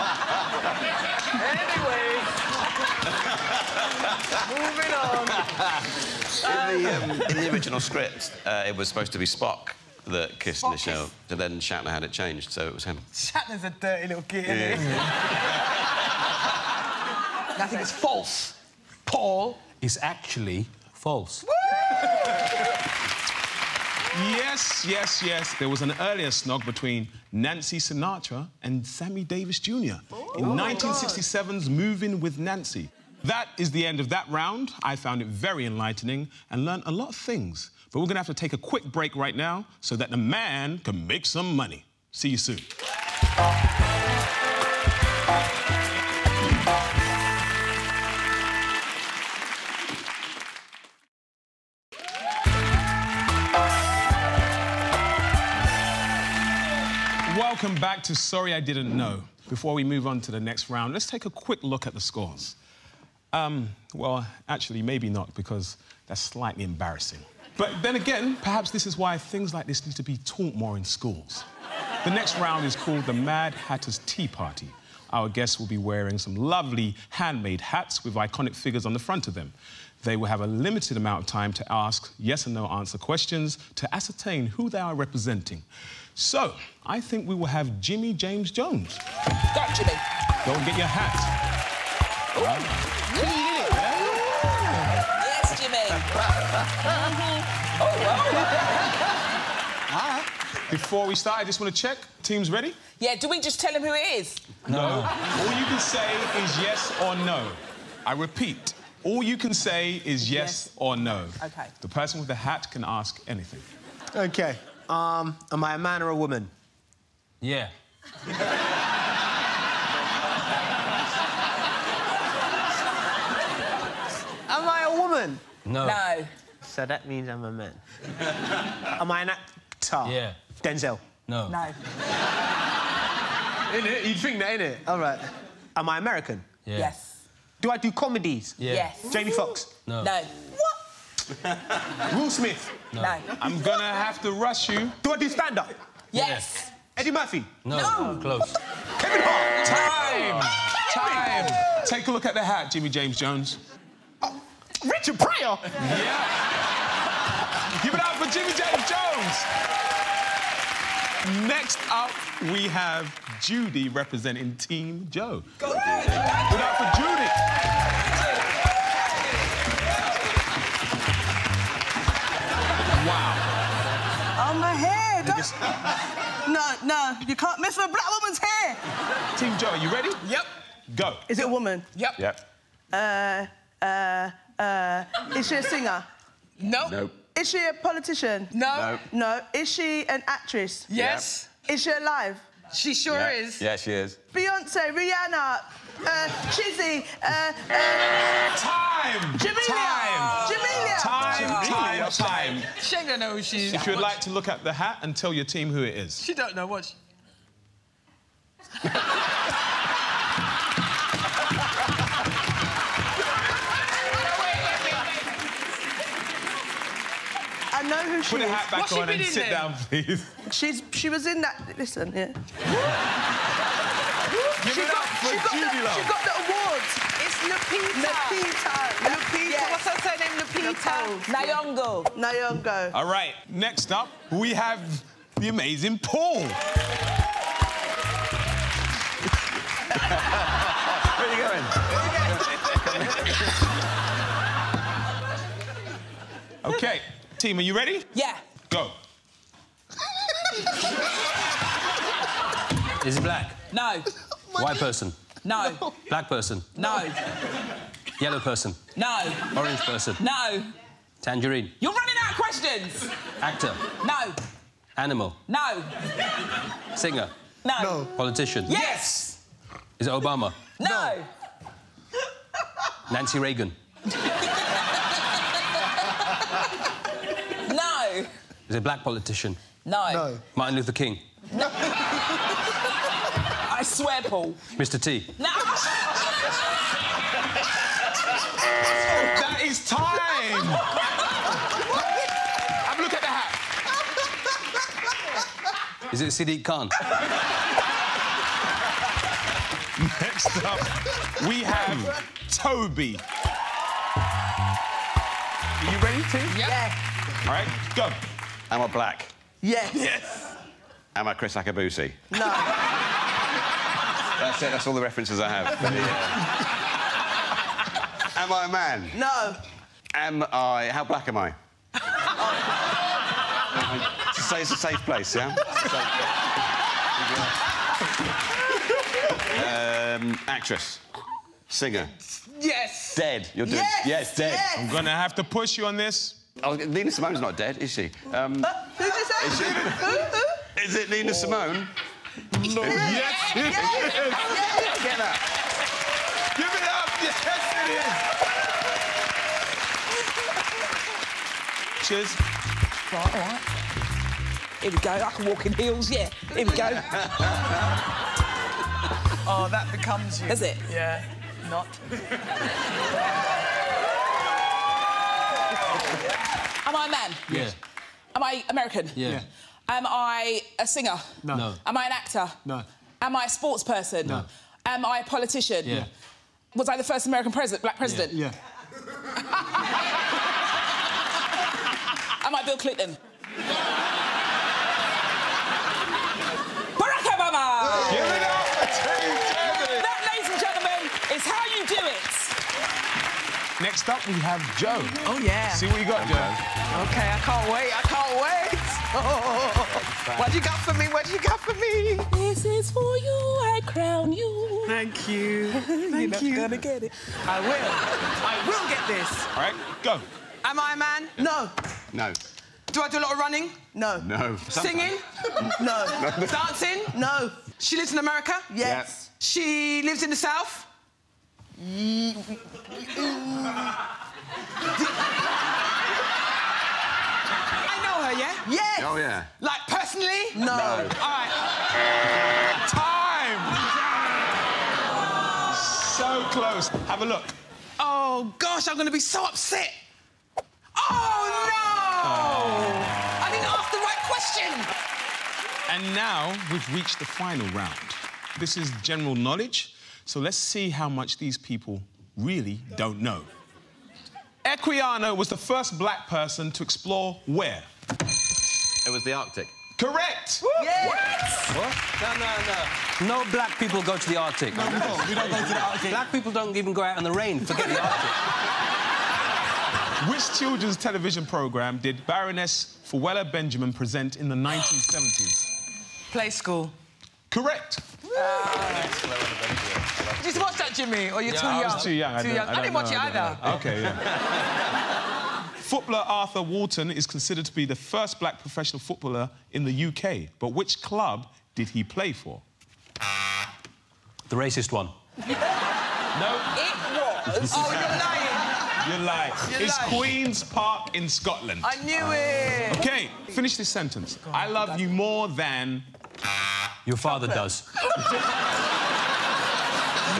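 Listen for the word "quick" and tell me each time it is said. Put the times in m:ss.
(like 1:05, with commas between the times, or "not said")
0:38, 1:01.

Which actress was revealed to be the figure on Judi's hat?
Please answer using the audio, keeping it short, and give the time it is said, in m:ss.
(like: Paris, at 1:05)
Lupita Nyong'o, at 3:50.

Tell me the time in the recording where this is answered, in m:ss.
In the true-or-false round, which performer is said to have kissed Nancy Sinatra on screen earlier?
0:28.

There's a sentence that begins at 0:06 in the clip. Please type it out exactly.
In the, um, in the original script, uh, it was supposed to be Spock that kissed Spock Nichelle, kiss.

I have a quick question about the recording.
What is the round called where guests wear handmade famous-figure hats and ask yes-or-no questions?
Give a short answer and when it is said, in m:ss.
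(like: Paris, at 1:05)
The Mad Hatter's Tea Party, at 1:13.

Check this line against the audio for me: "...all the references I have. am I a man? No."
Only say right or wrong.
right.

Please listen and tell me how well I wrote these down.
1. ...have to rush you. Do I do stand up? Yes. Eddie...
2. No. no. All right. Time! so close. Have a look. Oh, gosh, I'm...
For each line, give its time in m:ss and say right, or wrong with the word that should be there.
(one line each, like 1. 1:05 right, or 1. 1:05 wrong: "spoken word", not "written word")
1. 2:23 right
2. 7:10 right.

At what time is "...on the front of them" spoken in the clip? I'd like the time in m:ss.
1:18.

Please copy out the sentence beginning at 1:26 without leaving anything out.
So, I think we will have Jimmy James Jones.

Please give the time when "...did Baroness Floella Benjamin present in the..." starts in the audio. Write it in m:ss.
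7:52.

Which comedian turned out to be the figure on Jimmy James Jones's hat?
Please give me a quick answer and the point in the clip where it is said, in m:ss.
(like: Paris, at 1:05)
Richard Pryor, at 2:34.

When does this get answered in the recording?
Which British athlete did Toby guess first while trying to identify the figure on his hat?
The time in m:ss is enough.
5:11.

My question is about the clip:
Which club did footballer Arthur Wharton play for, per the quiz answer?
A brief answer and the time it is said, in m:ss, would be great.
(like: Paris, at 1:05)
Queen's Park, at 8:20.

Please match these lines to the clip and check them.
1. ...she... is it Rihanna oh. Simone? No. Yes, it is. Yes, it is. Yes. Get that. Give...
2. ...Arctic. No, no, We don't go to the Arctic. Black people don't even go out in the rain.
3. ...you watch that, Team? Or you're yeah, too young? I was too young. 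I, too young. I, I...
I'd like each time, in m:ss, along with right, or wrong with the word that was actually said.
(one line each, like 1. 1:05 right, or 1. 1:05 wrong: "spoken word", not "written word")
1. 5:39 wrong: "Nina", not "Rihanna"
2. 7:44 right
3. 8:00 wrong: "Jimmy", not "Team".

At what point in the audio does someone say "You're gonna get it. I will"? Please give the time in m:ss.
6:46.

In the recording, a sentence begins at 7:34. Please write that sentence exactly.
Equiano was the first black person to explore where?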